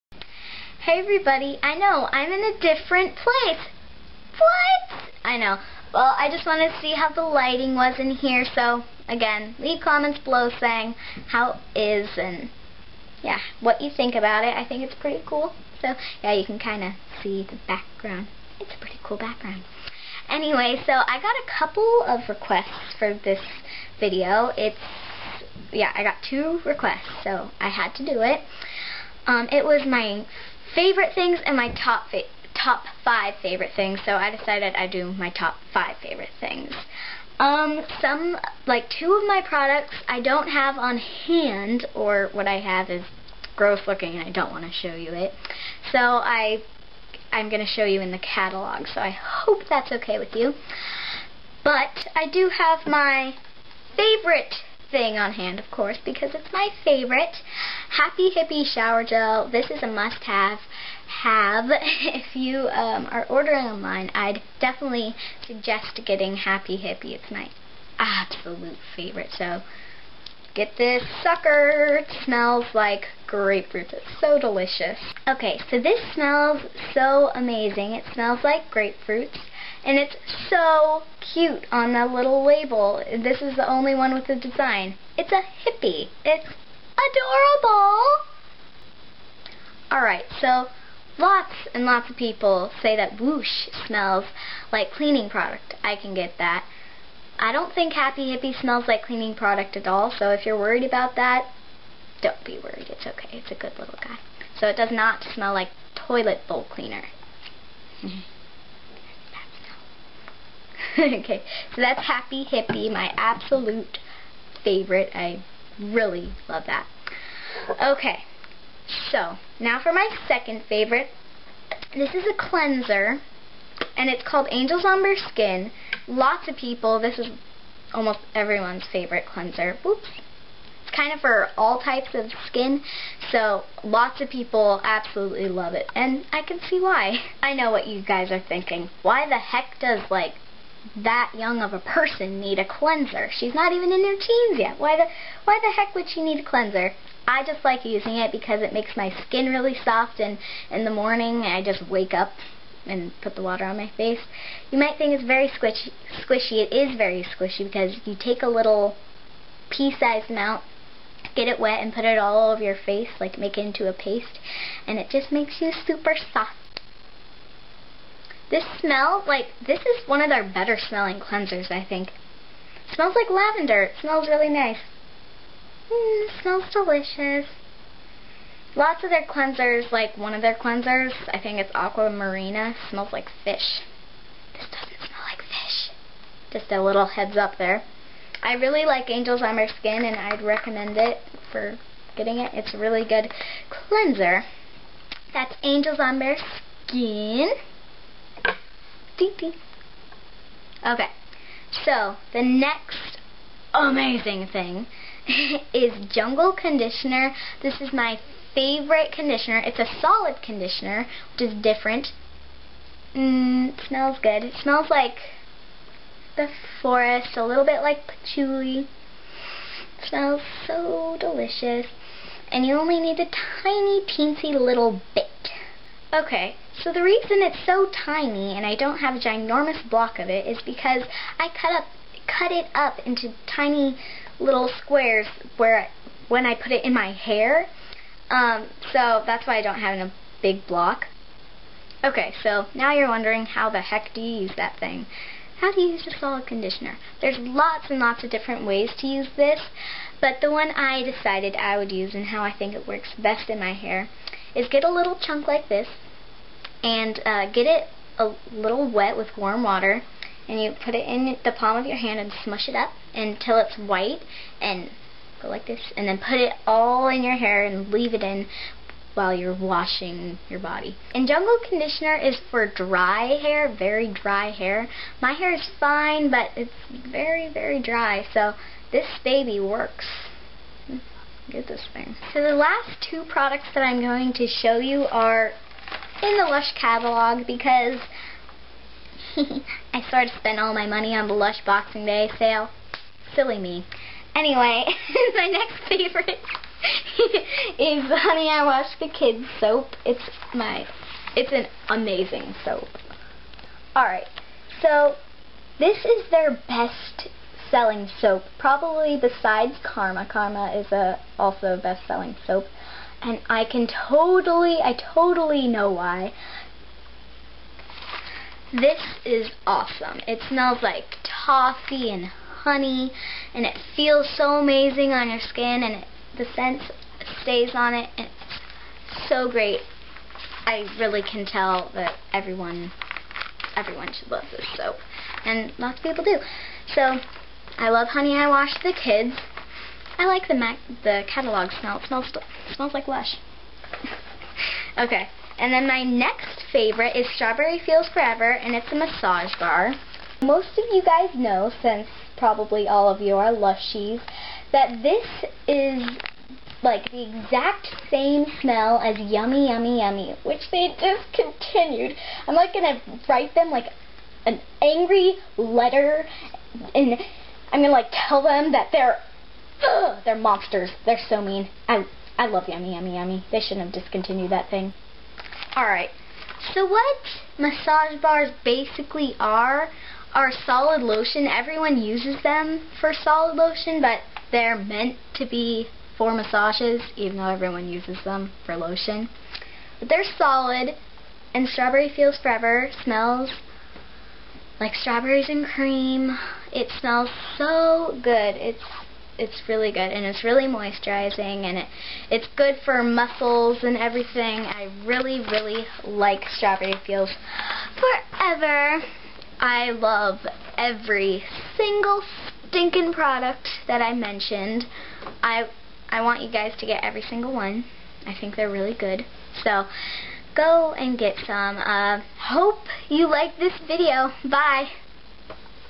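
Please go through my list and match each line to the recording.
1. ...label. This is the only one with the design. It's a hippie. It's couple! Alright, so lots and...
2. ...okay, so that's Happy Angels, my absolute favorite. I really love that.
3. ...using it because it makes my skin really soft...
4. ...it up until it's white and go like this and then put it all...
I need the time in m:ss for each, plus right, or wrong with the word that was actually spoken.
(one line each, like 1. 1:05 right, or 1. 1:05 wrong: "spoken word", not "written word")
1. 1:22 wrong: "adorable", not "couple"
2. 1:50 wrong: "Hippy", not "Angels"
3. 2:27 right
4. 4:22 right.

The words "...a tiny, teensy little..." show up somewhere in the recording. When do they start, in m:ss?
3:43.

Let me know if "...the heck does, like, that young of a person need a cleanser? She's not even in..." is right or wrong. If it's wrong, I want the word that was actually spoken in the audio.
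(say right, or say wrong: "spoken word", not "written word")
right.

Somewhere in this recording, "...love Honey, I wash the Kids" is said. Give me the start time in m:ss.
5:37.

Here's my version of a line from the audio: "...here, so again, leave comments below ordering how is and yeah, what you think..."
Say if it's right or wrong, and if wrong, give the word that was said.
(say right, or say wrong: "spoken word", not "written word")
wrong: "saying", not "ordering".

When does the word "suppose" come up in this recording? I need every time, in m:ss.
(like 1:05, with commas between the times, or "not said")
not said.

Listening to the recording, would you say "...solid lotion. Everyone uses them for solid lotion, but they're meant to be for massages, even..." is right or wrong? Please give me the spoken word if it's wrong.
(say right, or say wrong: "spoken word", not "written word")
right.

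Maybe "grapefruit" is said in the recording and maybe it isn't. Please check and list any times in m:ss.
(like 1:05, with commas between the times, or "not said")
1:13, 1:18.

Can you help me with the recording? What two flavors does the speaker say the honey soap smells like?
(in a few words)
Toffee and honey.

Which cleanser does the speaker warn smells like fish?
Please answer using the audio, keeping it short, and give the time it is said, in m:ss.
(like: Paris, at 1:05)
Aqua Marina, at 3:01.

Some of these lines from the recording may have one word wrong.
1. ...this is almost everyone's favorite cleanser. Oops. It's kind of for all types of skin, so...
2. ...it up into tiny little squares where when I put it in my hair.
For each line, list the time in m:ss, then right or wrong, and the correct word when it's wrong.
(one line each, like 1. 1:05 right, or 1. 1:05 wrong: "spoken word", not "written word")
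1. 2:06 right
2. 3:52 right.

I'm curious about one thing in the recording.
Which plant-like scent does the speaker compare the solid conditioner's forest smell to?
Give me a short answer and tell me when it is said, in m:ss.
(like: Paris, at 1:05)
Patchouli, at 3:38.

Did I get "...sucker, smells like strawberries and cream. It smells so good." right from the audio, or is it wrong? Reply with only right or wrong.
wrong.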